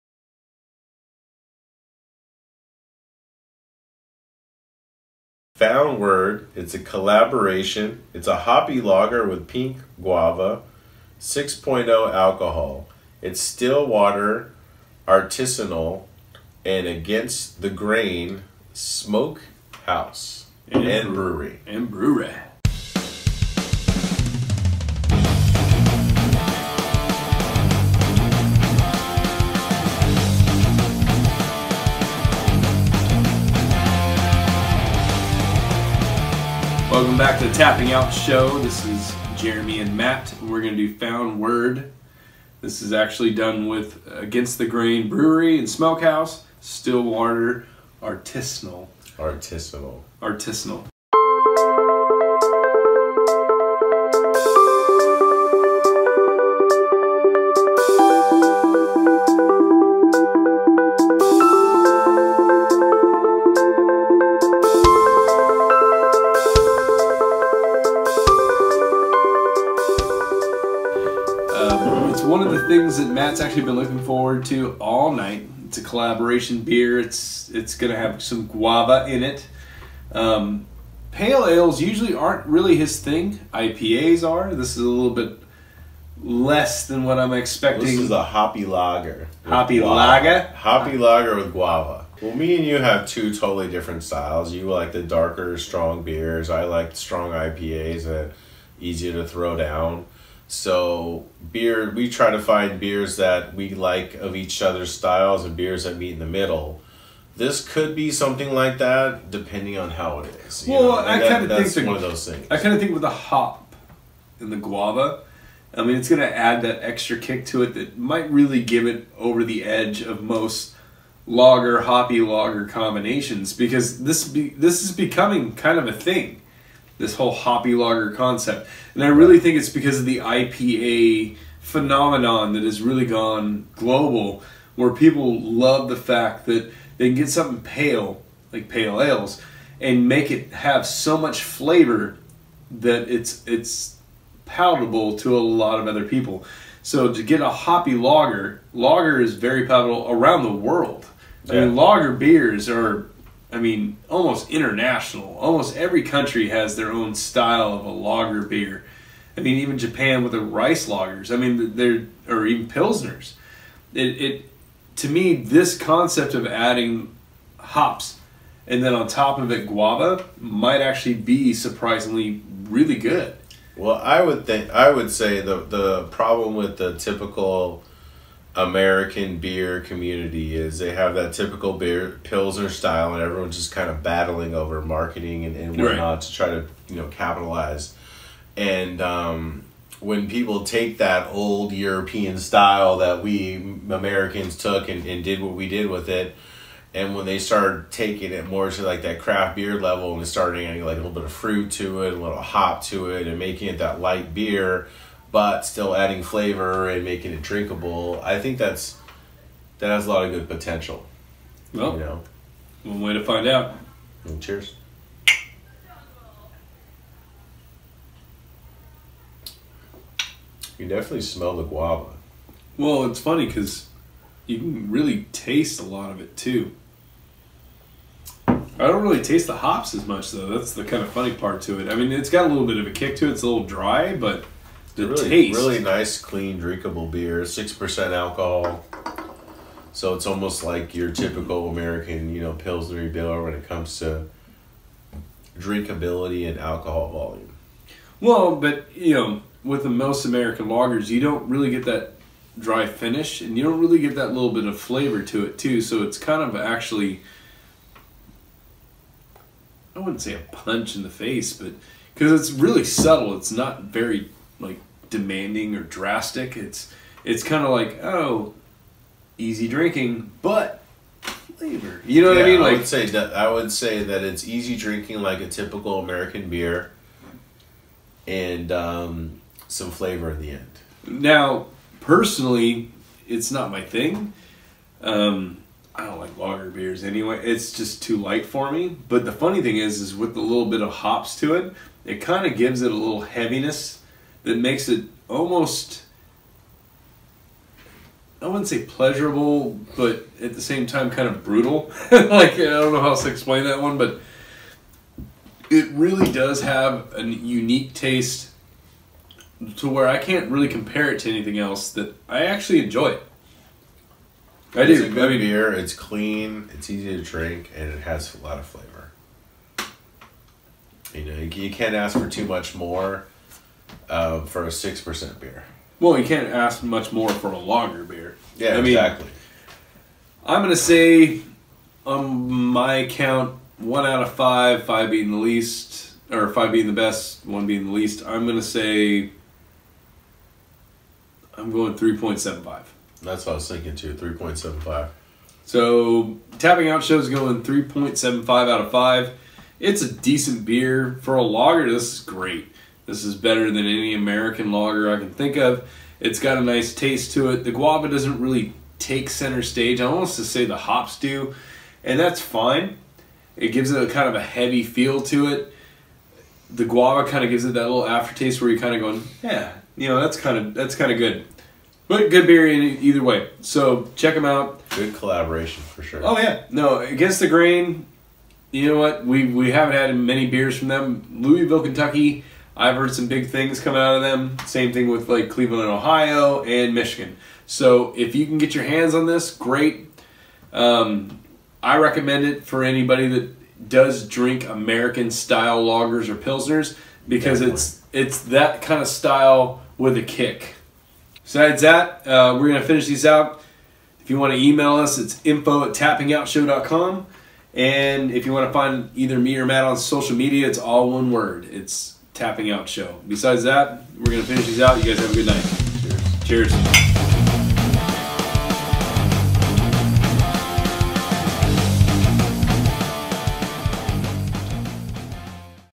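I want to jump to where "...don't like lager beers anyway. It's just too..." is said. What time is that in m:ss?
4:46.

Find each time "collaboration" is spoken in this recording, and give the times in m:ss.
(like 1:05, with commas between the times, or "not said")
0:06, 1:15, 6:15.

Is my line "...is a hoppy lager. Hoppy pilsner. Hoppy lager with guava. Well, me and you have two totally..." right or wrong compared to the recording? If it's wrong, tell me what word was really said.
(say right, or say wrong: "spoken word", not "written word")
wrong: "lager", not "pilsner".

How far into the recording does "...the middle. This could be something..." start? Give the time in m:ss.
1:46.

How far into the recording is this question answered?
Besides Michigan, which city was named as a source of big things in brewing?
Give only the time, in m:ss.
6:25.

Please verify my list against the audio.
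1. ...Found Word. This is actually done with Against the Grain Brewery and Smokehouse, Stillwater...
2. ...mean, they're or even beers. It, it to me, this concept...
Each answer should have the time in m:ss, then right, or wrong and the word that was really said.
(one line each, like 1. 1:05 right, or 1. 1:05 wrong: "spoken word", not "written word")
1. 0:40 right
2. 2:41 wrong: "pilsners", not "beers".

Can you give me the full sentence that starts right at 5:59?
I almost to say the hops do, and that's fine.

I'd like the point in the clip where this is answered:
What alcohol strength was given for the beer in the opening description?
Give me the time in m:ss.
0:11.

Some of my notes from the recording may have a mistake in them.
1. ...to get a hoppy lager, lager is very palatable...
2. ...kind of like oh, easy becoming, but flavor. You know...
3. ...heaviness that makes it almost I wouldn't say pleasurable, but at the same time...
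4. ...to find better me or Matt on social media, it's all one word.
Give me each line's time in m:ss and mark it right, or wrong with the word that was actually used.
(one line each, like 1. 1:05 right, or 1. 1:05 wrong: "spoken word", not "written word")
1. 2:27 right
2. 4:27 wrong: "drinking", not "becoming"
3. 4:53 right
4. 6:48 wrong: "either", not "better".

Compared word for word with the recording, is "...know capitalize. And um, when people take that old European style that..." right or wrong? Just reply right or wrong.
right.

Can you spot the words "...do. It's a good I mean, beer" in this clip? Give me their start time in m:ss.
5:14.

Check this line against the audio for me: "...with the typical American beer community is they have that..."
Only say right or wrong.
right.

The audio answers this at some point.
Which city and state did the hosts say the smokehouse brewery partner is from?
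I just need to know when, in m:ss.
6:21.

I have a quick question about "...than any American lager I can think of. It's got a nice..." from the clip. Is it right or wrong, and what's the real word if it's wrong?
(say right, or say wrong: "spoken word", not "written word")
right.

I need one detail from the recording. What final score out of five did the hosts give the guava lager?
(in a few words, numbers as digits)
3.75.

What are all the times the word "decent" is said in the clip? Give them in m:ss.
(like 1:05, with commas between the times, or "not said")
5:50.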